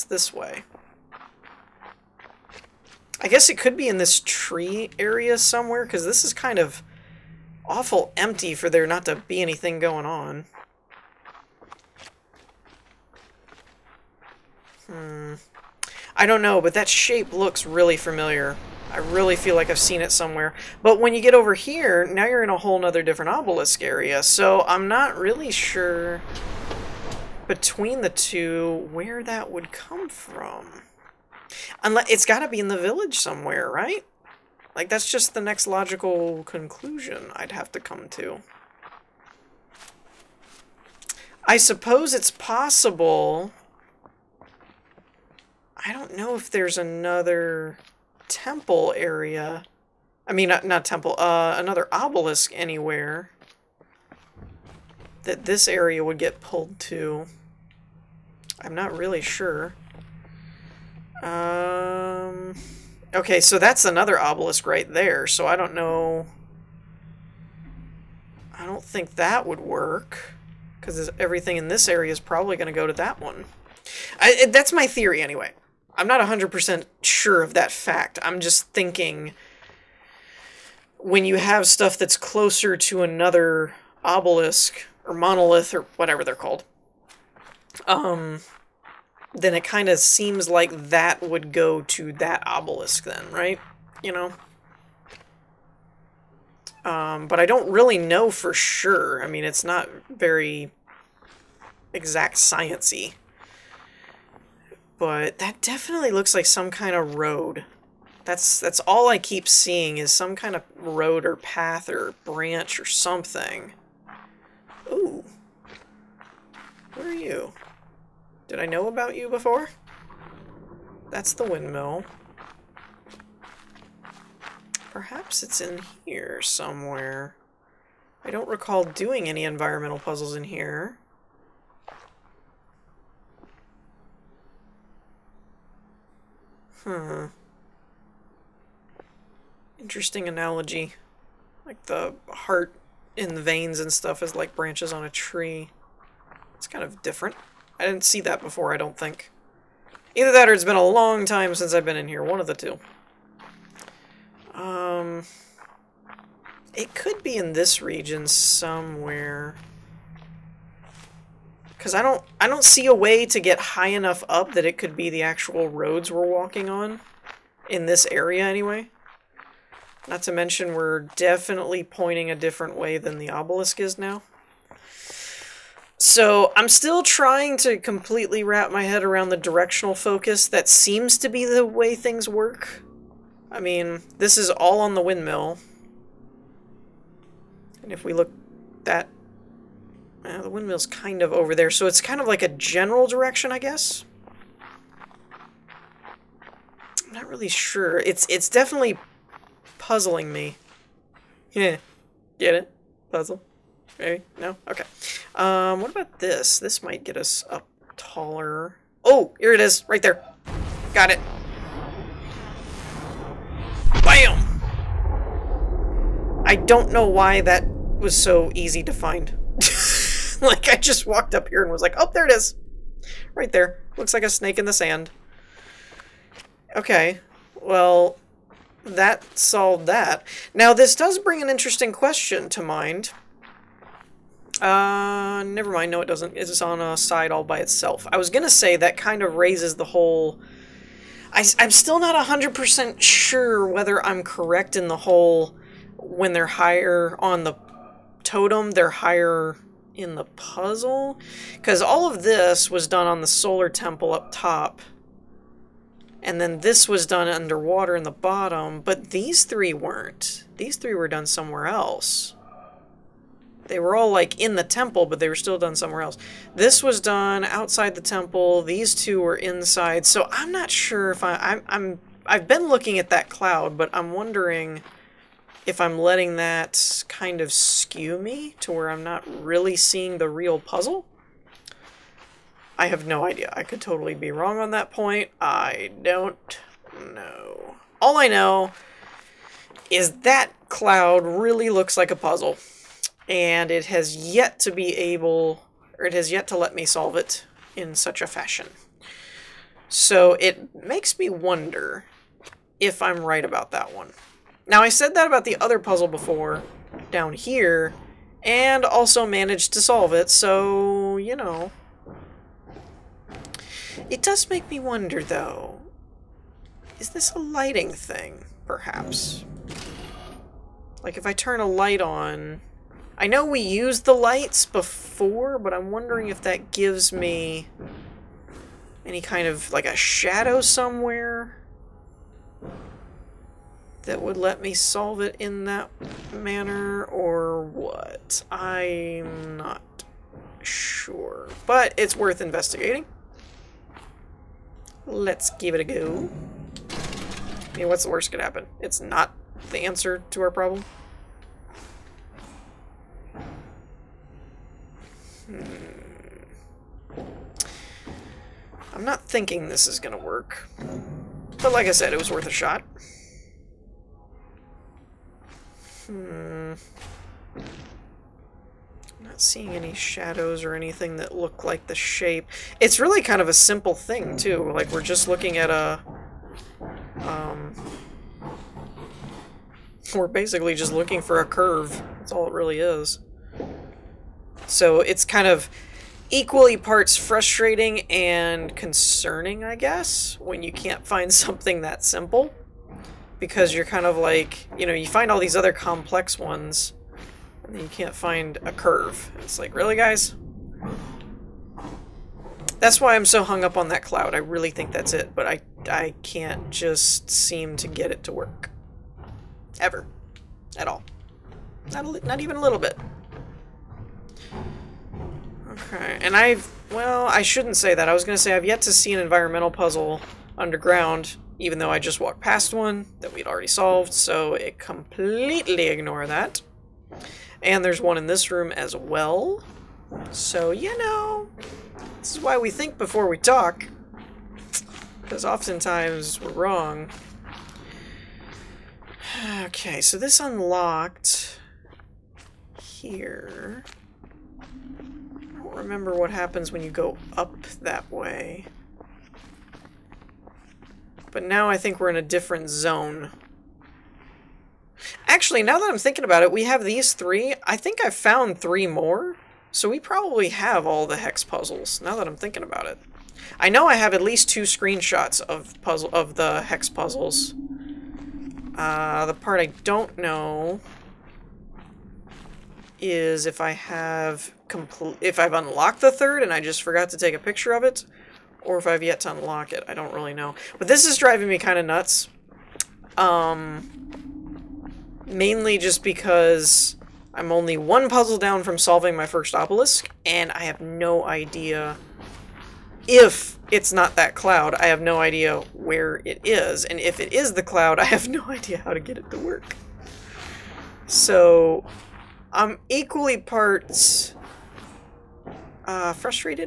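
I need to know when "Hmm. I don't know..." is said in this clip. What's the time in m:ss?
0:14.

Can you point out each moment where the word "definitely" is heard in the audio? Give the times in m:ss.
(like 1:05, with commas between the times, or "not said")
1:45, 2:51, 3:18.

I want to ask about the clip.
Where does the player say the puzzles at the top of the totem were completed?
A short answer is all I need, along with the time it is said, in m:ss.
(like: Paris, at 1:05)
The solar temple, at 4:13.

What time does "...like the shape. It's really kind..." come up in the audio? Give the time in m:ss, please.
6:11.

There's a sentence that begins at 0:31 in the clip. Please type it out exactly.
Unless it's got to be in the village somewhere, right?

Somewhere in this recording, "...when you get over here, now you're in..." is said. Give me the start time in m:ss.
0:21.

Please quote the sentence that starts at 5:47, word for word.
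I mean, what's the worst could happen?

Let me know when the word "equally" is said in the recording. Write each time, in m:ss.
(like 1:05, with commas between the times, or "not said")
6:26, 8:22.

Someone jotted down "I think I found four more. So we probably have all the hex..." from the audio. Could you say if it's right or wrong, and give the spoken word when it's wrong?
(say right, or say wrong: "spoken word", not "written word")
wrong: "three", not "four".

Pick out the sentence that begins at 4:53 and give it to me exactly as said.
And it has yet to be able, or it has yet to let me solve it in such a fashion.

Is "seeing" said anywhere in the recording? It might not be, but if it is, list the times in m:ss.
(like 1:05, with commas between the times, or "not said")
1:49, 4:39, 6:09.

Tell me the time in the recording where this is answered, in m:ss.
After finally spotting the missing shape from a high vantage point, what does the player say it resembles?
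3:44.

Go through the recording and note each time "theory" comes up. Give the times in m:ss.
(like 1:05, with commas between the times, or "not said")
1:14.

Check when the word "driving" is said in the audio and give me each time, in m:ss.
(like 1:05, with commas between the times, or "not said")
8:01.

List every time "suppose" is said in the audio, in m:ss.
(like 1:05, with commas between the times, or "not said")
0:41.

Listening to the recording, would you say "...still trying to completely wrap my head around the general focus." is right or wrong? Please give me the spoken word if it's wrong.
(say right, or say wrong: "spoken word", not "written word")
wrong: "directional", not "general".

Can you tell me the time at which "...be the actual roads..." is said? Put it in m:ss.
2:44.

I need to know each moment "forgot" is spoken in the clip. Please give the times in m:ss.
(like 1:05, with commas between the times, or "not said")
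7:56.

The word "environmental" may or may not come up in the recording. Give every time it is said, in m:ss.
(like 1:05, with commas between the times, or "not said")
2:09, 6:59.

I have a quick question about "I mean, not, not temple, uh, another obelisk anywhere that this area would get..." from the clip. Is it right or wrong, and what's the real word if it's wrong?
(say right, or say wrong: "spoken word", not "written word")
right.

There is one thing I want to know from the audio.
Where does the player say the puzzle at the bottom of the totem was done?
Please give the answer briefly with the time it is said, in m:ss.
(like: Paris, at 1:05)
Underwater, at 4:17.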